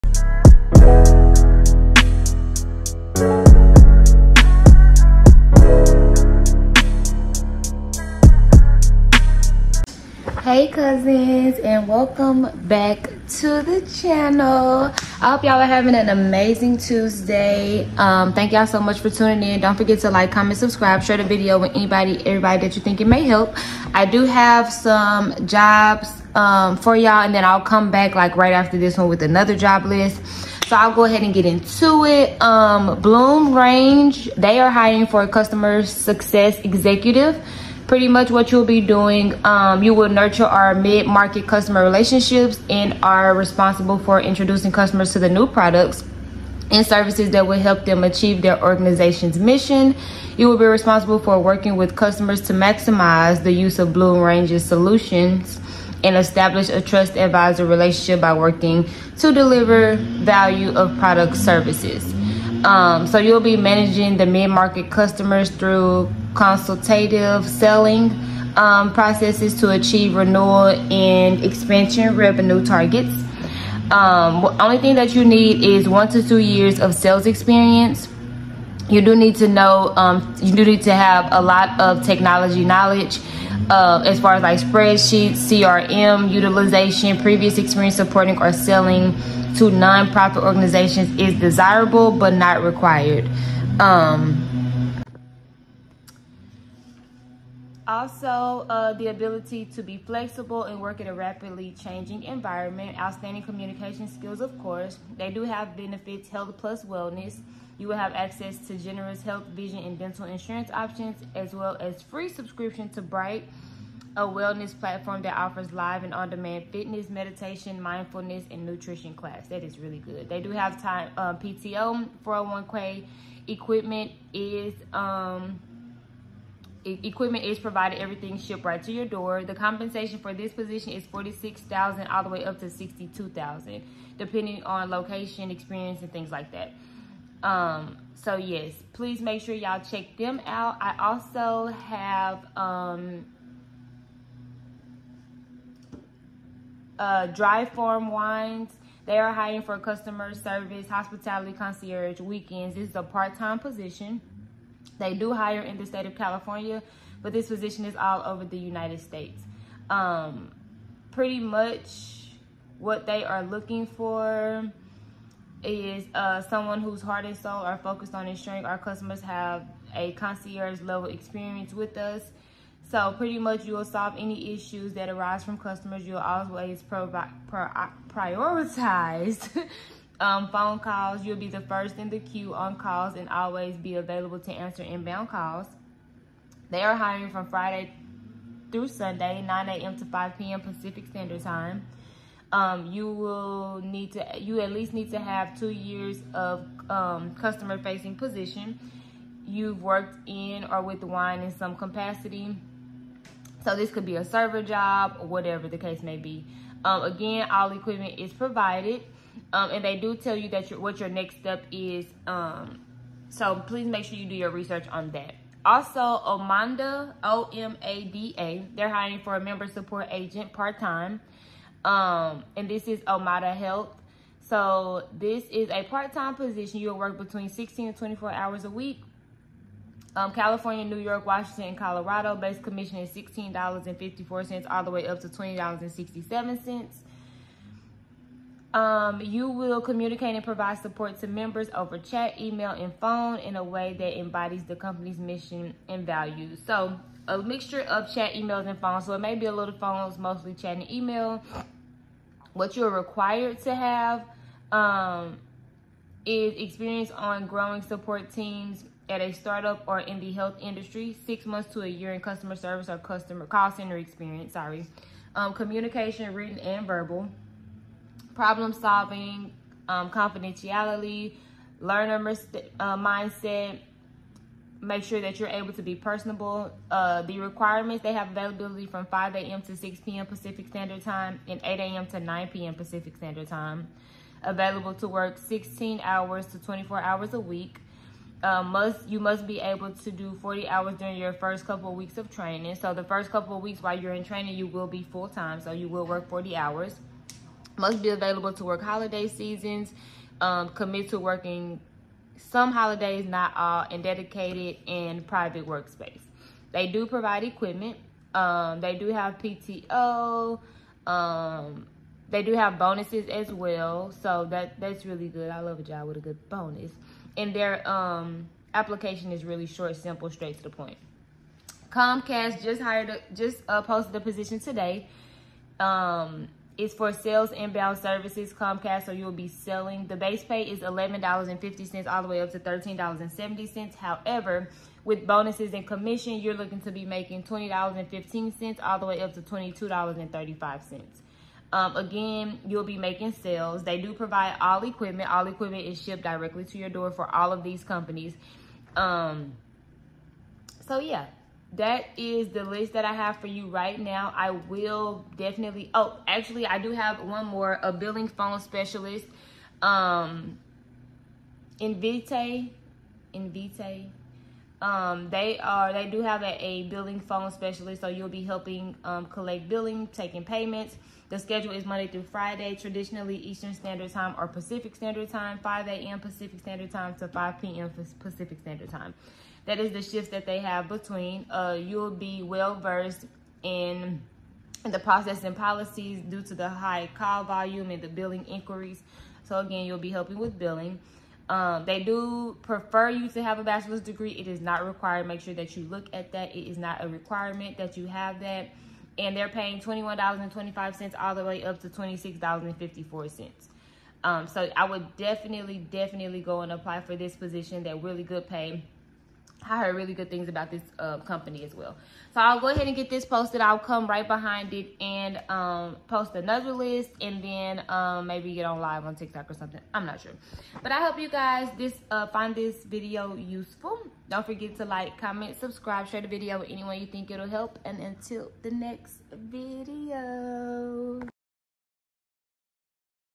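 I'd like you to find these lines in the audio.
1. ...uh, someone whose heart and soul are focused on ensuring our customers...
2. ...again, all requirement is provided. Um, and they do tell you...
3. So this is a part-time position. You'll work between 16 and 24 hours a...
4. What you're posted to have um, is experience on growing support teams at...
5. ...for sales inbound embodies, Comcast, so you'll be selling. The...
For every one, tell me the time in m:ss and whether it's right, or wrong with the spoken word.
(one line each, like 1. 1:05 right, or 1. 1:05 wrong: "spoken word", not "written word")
1. 2:46 right
2. 3:27 wrong: "equipment", not "requirement"
3. 3:44 right
4. 4:12 wrong: "required", not "posted"
5. 5:26 wrong: "services", not "embodies".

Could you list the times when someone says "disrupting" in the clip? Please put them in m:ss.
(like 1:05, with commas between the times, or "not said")
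not said.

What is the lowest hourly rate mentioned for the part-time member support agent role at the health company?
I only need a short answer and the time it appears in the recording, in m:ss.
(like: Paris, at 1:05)
$16.54, at 3:53.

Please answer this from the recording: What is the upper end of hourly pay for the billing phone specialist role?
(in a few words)
$26.54.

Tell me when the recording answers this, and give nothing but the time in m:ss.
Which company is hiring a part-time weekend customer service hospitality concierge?
2:27.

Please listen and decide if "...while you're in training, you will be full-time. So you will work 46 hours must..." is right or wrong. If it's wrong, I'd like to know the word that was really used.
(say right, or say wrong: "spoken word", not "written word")
wrong: "40", not "46".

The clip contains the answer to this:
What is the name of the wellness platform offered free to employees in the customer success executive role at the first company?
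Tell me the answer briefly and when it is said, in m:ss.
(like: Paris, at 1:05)
Bright, at 1:53.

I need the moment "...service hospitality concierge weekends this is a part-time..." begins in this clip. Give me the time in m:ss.
2:30.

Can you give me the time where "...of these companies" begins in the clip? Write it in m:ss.
5:47.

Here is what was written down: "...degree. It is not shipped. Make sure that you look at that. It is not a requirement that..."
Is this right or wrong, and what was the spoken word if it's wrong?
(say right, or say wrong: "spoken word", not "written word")
wrong: "required", not "shipped".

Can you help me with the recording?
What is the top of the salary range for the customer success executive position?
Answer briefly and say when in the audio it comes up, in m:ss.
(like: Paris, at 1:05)
62,000, at 2:12.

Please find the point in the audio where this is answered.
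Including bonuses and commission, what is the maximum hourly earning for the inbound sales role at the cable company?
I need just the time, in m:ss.
5:39.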